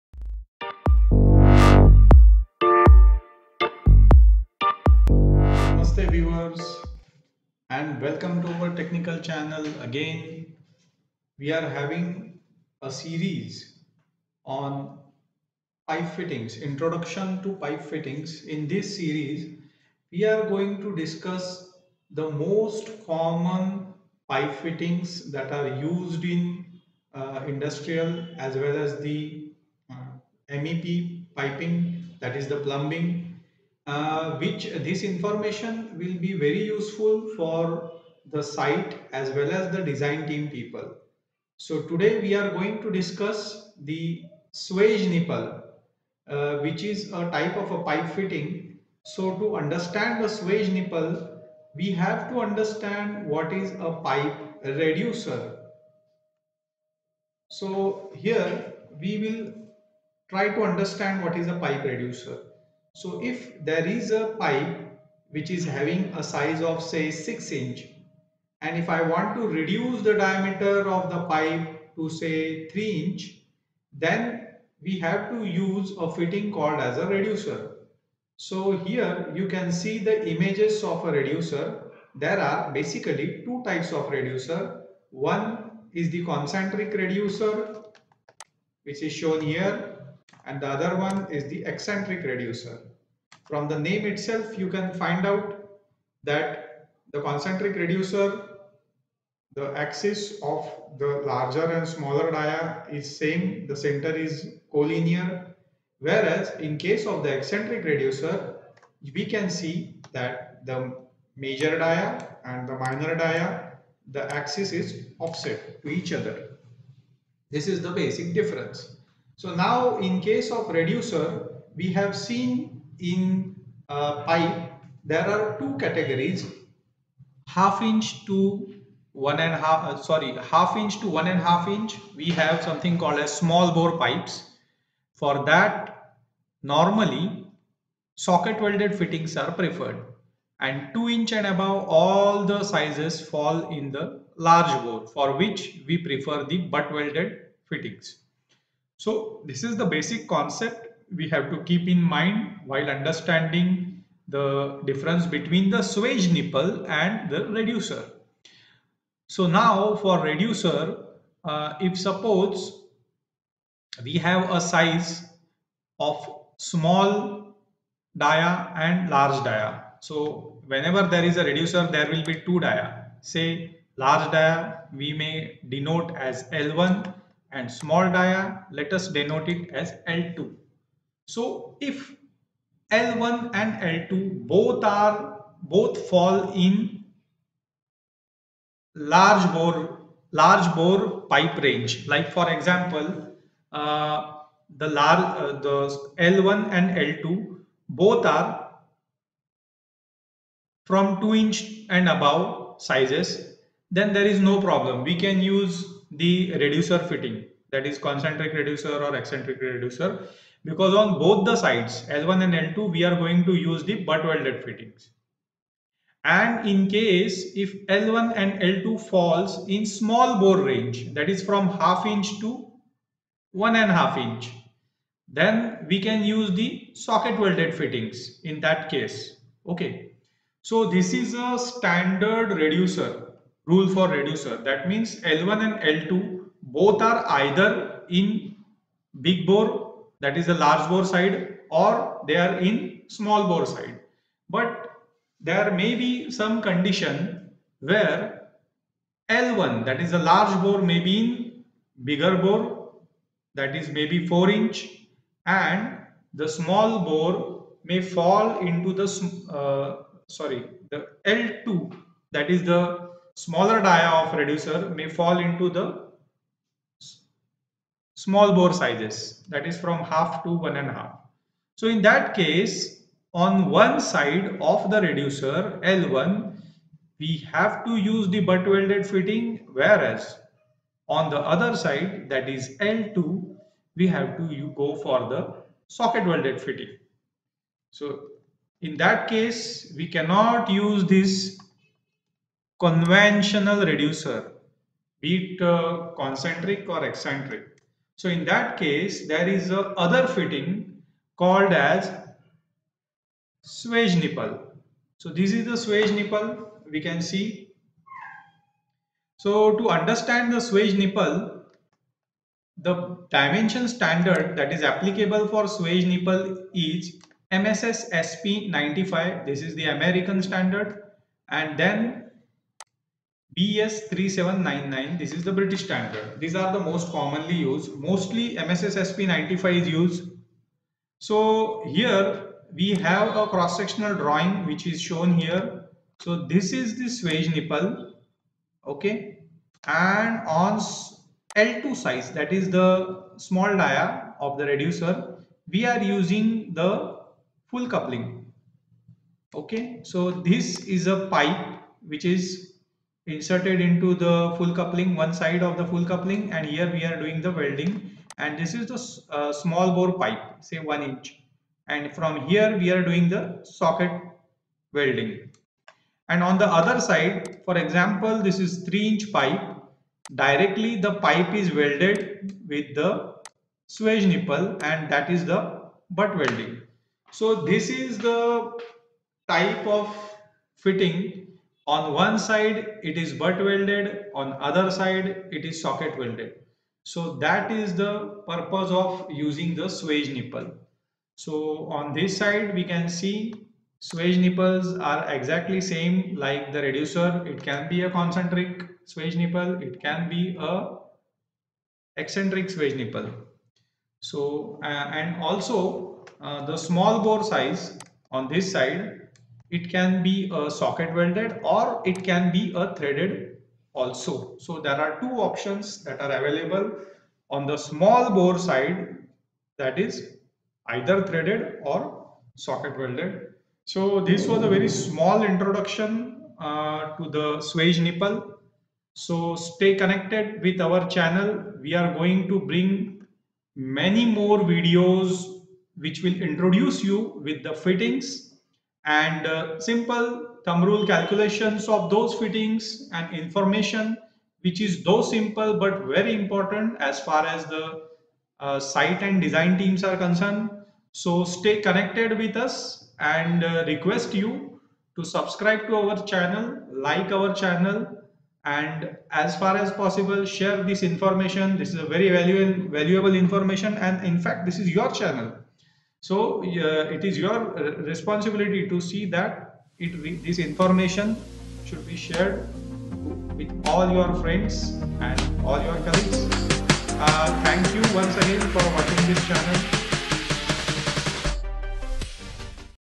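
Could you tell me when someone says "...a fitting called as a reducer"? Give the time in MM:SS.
01:15.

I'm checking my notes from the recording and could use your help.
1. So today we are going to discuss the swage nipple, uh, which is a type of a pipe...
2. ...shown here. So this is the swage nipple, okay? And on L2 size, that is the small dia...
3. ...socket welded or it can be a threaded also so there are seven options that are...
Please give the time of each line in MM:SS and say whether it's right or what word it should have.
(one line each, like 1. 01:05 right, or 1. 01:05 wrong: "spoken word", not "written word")
1. 00:41 right
2. 05:35 right
3. 06:50 wrong: "two", not "seven".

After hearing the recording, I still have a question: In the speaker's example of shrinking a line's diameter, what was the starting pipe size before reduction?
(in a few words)
6 inch.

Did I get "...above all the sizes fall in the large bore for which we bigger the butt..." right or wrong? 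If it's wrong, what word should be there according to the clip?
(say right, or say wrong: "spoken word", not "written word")
wrong: "prefer", not "bigger".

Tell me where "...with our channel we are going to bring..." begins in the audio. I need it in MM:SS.
07:10.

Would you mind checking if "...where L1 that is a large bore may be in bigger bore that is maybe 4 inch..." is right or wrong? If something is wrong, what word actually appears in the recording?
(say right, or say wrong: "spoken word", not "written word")
right.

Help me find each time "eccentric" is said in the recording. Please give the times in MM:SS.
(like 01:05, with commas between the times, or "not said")
01:31, 01:47, 03:29, 04:57, 06:42.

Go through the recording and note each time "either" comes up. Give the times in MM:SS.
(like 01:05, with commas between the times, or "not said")
03:57, 07:00.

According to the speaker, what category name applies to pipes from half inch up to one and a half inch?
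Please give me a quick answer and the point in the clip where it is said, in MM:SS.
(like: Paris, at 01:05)
Small bore pipes, at 02:13.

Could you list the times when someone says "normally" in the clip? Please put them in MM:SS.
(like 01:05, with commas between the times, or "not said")
02:16.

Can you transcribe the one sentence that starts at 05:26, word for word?
These are the most commonly used.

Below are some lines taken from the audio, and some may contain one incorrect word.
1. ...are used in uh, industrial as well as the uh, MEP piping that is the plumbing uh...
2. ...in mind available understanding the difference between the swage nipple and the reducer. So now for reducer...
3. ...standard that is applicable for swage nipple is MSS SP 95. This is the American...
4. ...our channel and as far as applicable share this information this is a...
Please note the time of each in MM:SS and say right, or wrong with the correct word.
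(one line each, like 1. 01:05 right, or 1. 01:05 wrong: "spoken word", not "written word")
1. 00:25 right
2. 02:31 wrong: "while", not "available"
3. 05:13 right
4. 07:37 wrong: "possible", not "applicable".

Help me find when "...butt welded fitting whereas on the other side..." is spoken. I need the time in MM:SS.
04:38.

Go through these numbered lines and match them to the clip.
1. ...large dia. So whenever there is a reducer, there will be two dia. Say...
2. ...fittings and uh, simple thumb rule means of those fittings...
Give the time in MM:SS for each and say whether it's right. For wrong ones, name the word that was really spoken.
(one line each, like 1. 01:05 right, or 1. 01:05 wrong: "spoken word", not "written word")
1. 02:49 right
2. 07:17 wrong: "calculations", not "means".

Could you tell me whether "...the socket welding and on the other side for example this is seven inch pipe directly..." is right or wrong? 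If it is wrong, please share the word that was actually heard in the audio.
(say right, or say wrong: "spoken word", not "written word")
wrong: "three", not "seven".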